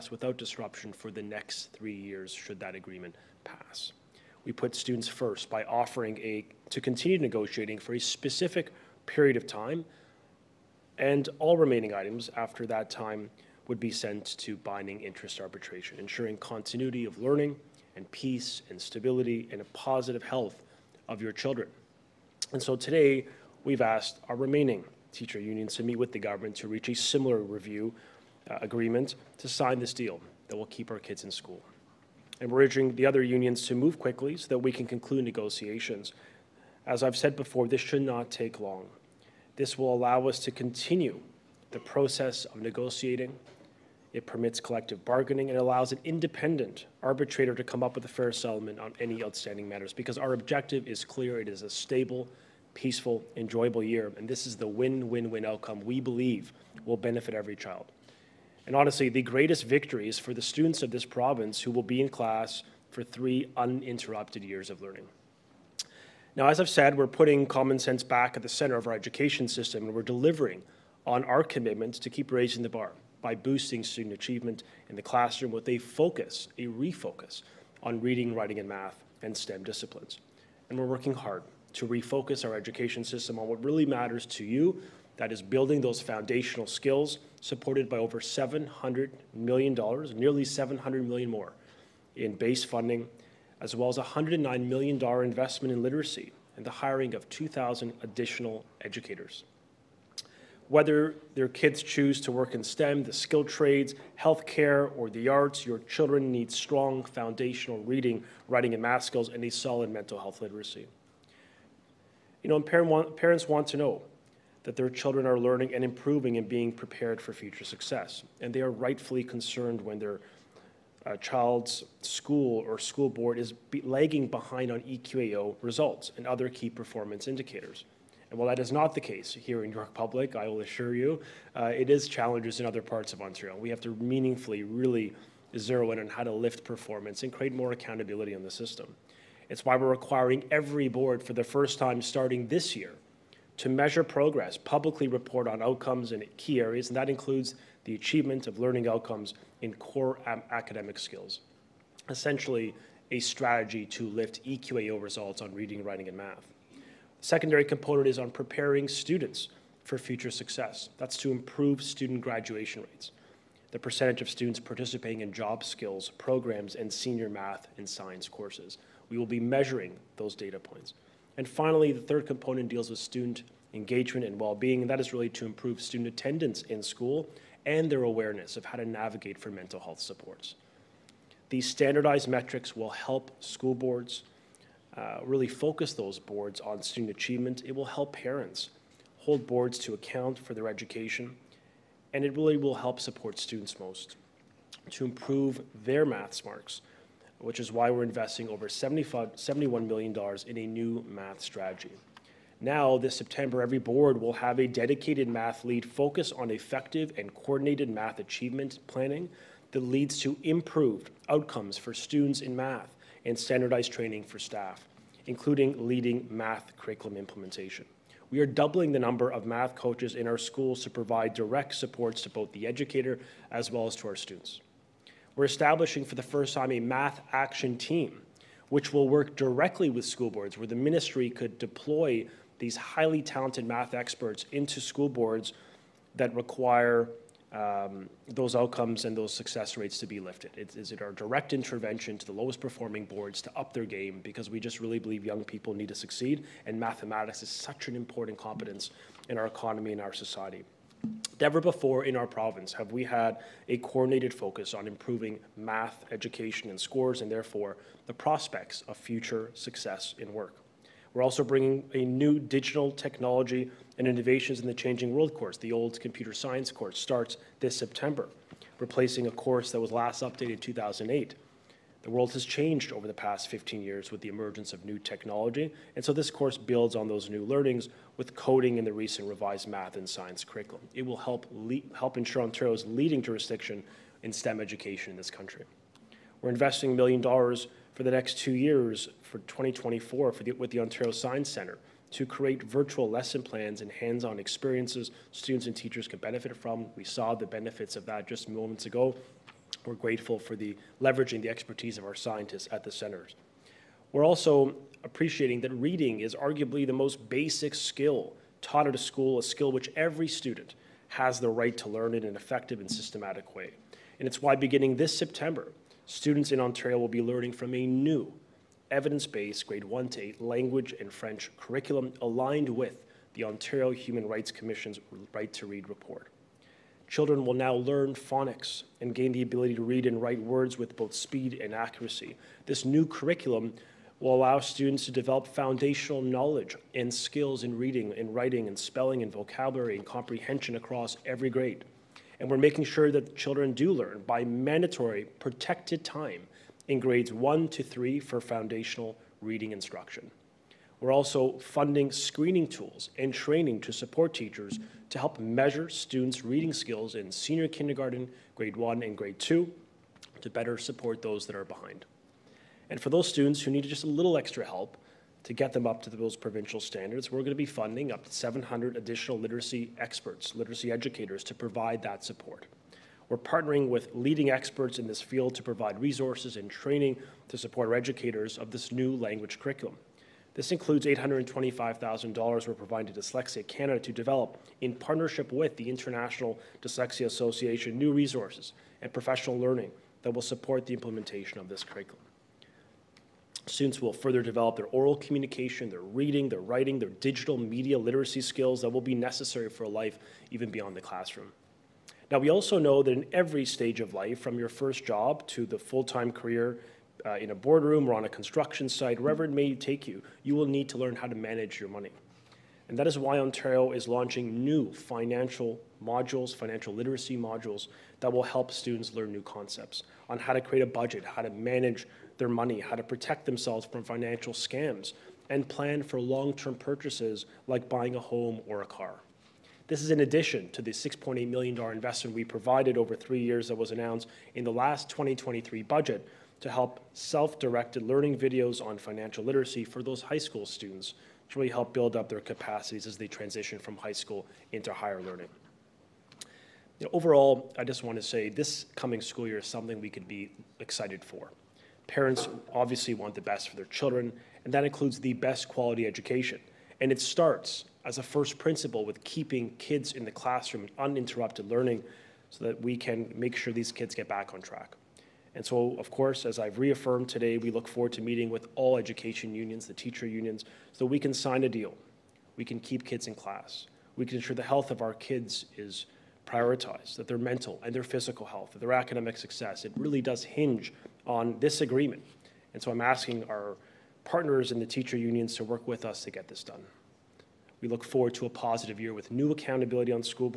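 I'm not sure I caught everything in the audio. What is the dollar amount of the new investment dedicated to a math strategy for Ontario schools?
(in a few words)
$71 million.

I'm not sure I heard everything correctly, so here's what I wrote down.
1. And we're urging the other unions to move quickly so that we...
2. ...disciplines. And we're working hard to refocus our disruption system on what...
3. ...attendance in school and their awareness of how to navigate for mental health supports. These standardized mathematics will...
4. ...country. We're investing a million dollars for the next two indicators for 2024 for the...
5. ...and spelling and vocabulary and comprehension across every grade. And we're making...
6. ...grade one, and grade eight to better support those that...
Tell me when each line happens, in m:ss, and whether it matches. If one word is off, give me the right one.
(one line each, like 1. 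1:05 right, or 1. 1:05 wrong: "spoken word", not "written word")
1. 0:32 right
2. 1:19 wrong: "education", not "disruption"
3. 2:56 wrong: "metrics", not "mathematics"
4. 4:45 wrong: "years", not "indicators"
5. 5:38 right
6. 5:58 wrong: "two", not "eight".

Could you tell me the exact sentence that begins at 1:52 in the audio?
You know, parent want, parents want to know that their children are learning and improving and being prepared for future success.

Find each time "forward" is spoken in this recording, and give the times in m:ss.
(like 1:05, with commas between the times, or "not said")
7:47, 8:08.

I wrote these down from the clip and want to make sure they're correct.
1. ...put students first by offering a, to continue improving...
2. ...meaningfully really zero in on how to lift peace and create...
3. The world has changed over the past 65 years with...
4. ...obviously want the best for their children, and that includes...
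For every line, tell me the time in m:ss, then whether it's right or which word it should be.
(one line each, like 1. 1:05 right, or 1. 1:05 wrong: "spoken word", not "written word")
1. 0:04 wrong: "negotiating", not "improving"
2. 2:13 wrong: "performance", not "peace"
3. 4:32 wrong: "15", not "65"
4. 7:32 right.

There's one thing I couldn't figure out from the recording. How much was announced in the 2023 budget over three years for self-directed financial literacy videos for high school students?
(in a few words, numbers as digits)
$6.8 million.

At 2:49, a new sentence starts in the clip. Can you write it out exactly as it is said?
We will be measuring those data points.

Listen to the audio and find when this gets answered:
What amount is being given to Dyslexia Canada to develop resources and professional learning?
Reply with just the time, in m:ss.
6:21.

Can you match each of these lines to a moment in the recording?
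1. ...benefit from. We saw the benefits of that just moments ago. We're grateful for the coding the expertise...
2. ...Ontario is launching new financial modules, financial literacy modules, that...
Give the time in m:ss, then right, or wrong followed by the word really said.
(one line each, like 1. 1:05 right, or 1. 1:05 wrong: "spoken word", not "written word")
1. 4:56 wrong: "leveraging", not "coding"
2. 6:53 right.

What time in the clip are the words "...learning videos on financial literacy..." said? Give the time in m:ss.
7:18.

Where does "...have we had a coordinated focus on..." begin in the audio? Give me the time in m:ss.
4:12.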